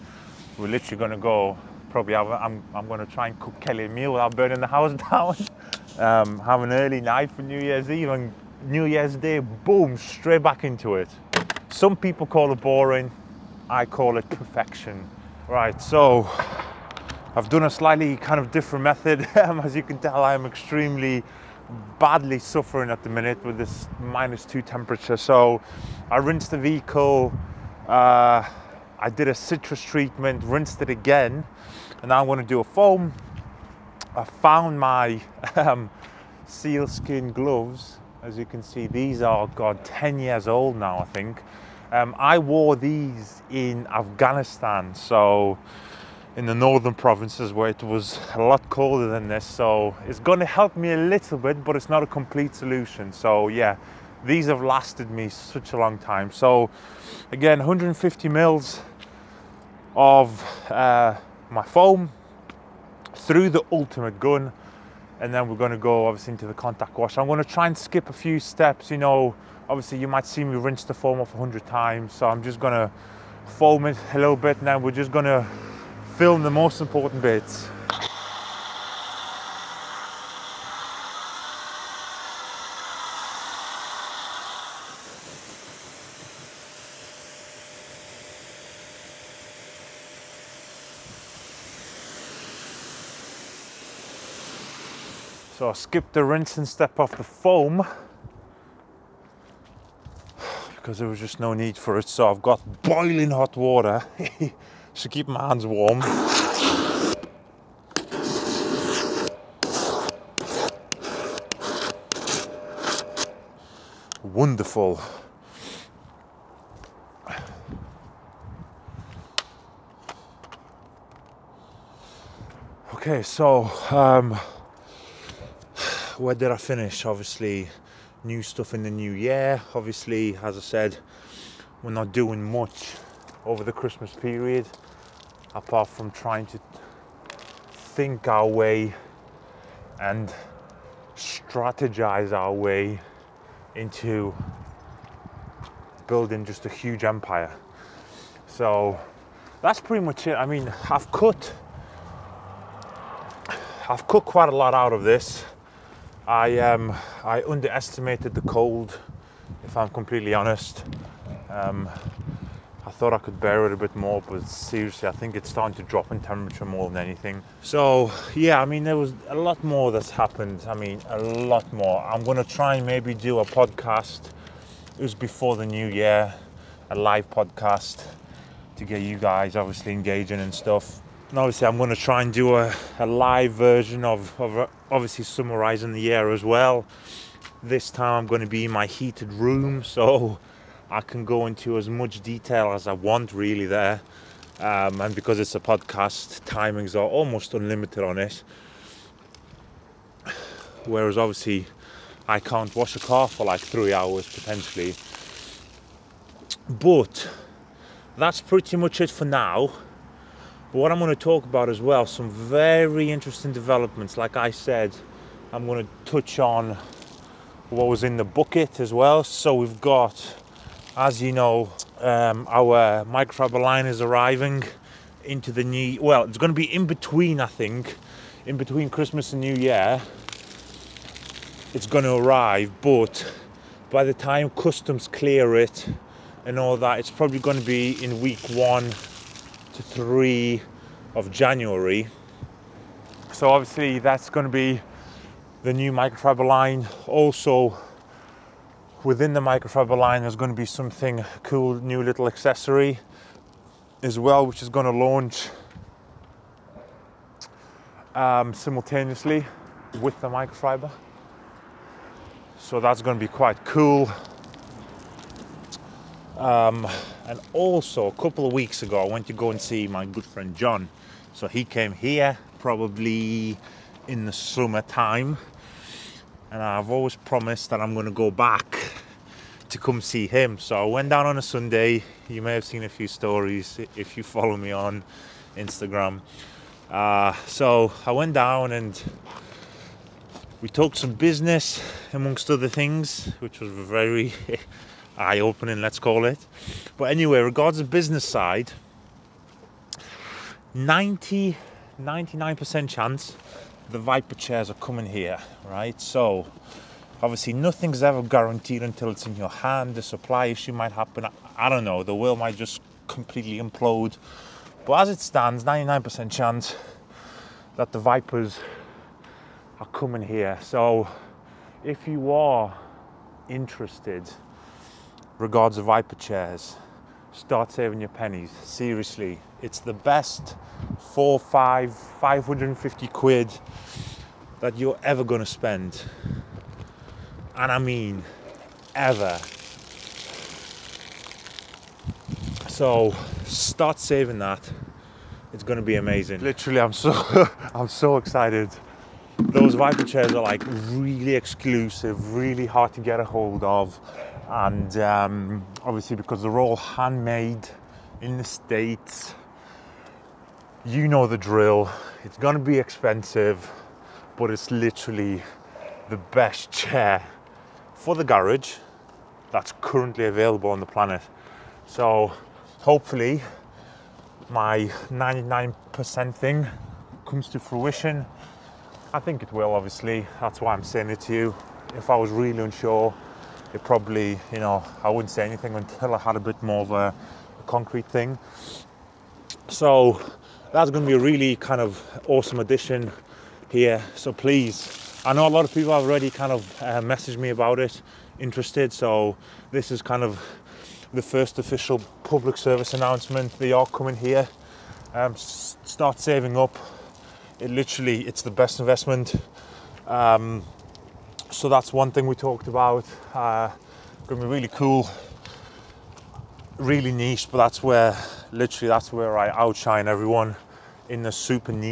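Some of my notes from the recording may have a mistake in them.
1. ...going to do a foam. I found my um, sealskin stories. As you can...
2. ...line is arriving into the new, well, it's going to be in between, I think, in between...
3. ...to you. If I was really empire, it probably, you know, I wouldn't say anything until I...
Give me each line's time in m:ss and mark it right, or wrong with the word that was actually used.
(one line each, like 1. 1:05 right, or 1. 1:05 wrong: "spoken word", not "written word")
1. 0:32 wrong: "gloves", not "stories"
2. 3:43 right
3. 6:21 wrong: "unsure", not "empire".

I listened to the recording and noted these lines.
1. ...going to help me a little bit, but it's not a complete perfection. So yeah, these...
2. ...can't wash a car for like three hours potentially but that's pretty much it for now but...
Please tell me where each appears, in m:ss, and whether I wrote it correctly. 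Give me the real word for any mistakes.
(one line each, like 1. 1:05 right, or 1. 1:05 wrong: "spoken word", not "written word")
1. 0:50 wrong: "solution", not "perfection"
2. 3:22 right.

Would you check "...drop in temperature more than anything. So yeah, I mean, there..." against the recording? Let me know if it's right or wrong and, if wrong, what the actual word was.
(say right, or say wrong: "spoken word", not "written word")
right.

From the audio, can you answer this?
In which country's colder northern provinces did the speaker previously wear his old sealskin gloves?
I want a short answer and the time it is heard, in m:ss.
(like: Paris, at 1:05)
Afghanistan, at 0:43.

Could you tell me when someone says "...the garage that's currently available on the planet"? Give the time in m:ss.
6:08.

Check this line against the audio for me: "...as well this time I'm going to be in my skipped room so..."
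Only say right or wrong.
wrong.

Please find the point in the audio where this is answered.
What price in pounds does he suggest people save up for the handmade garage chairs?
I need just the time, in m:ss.
5:31.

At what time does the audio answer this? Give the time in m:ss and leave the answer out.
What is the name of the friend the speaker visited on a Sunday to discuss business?
4:30.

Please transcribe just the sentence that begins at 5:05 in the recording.
So obviously nothing's ever guaranteed until it's in your hand.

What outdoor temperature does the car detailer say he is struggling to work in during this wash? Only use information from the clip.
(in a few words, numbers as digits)
-2.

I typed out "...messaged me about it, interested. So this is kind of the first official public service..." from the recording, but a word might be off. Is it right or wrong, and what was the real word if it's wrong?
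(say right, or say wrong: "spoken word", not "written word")
right.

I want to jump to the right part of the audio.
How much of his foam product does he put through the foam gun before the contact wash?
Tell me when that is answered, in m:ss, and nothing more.
0:57.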